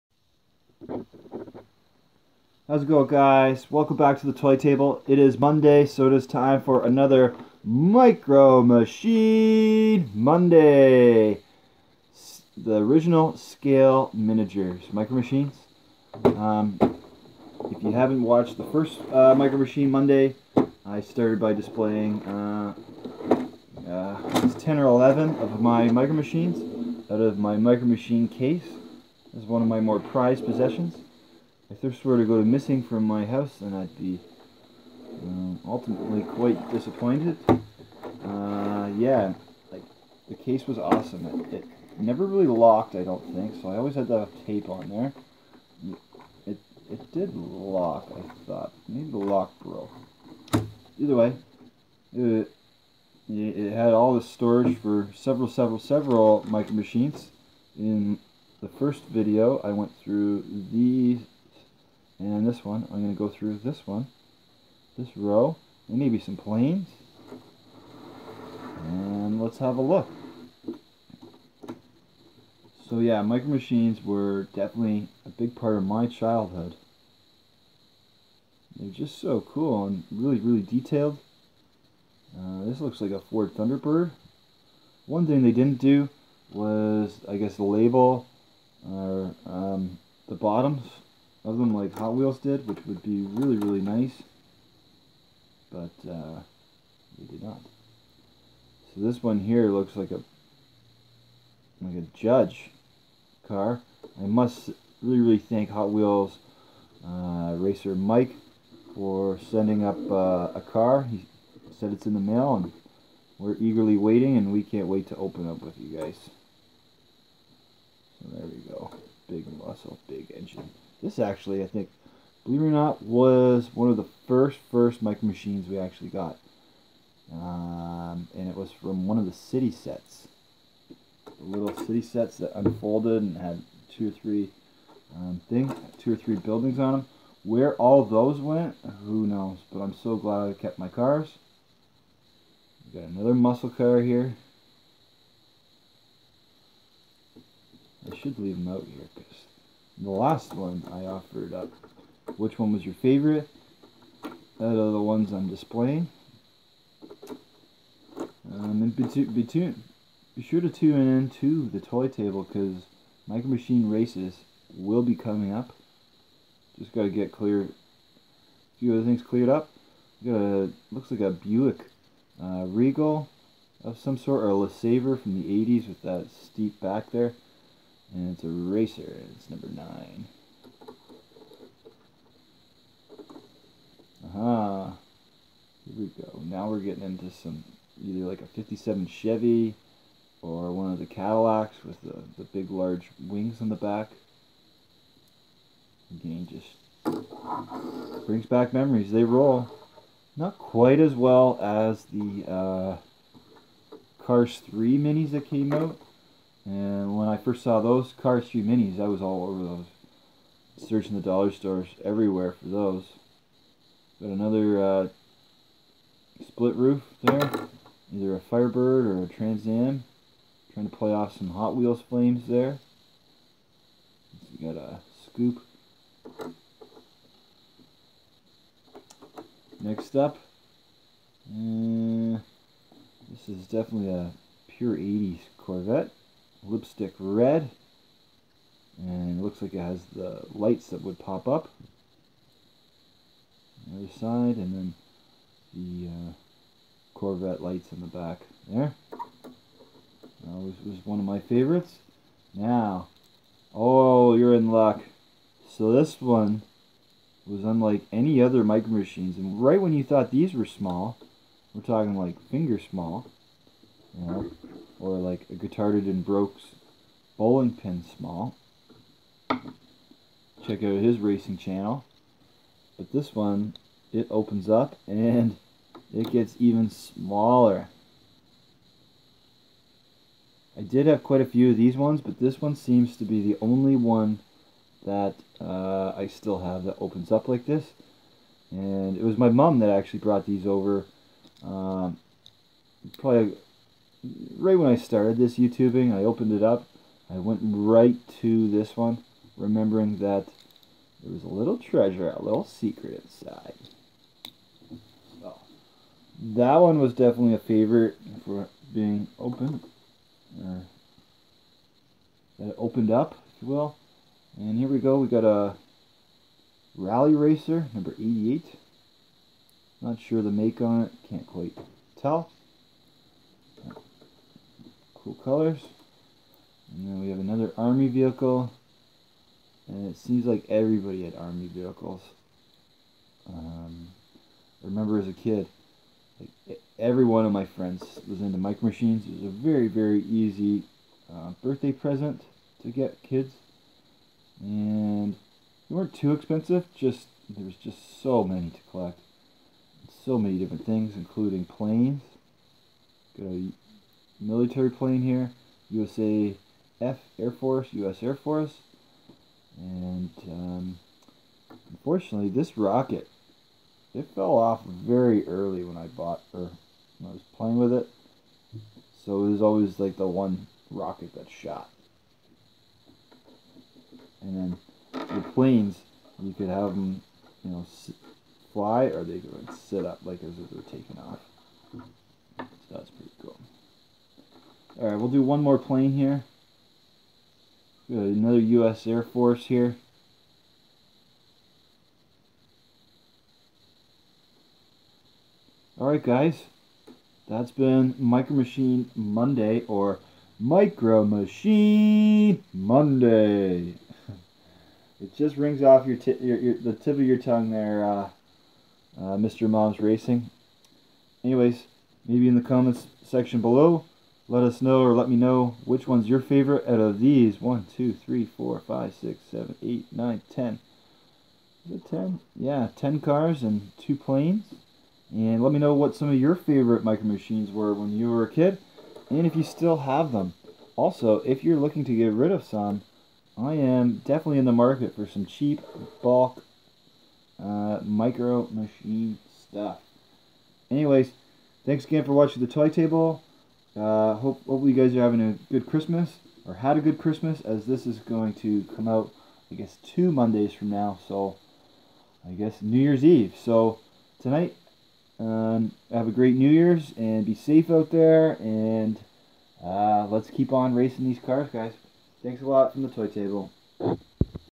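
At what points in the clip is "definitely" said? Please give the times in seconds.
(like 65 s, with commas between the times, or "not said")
74 s, 233 s, 307 s, 434 s.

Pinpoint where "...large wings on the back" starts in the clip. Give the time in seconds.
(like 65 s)
192 s.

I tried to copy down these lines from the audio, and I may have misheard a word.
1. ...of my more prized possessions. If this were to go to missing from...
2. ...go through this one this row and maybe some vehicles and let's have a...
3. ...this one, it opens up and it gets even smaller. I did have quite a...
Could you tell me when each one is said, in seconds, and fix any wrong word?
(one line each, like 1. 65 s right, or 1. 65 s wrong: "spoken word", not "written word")
1. 29 s right
2. 63 s wrong: "planes", not "vehicles"
3. 273 s right.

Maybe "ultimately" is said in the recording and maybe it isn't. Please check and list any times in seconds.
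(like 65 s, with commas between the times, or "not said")
35 s.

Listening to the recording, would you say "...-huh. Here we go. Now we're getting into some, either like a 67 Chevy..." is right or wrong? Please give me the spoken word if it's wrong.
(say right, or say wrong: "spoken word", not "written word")
wrong: "57", not "67".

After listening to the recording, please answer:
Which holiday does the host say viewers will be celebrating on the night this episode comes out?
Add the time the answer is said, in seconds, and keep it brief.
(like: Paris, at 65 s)
New Year's Eve, at 452 s.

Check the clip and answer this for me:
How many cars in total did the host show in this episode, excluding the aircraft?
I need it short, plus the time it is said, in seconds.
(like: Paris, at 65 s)
10, at 422 s.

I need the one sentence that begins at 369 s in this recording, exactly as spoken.
So it was always like the one rocket that shot.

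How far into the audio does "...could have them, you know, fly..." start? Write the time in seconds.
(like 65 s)
376 s.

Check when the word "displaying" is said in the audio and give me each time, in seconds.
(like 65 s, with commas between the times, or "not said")
21 s, 155 s.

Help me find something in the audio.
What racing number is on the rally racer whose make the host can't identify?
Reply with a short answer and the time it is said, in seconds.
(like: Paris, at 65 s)
88, at 317 s.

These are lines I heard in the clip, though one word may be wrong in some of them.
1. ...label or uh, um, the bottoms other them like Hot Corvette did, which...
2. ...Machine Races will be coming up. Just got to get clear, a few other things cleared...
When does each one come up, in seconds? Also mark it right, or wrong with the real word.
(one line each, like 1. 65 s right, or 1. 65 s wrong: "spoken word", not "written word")
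1. 87 s wrong: "Wheels", not "Corvette"
2. 163 s right.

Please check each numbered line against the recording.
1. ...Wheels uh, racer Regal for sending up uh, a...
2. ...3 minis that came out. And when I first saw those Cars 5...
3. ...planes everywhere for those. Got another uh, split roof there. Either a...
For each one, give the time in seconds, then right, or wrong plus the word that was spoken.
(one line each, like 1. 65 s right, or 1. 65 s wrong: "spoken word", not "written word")
1. 105 s wrong: "Mike", not "Regal"
2. 204 s wrong: "3", not "5"
3. 211 s wrong: "stores", not "planes".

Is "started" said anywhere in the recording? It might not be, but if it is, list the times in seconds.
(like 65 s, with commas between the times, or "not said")
21 s, 294 s.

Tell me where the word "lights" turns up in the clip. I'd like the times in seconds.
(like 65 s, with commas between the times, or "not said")
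240 s, 247 s.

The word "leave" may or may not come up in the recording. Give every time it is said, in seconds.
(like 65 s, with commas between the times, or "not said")
148 s.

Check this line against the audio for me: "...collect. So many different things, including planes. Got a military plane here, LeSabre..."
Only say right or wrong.
wrong.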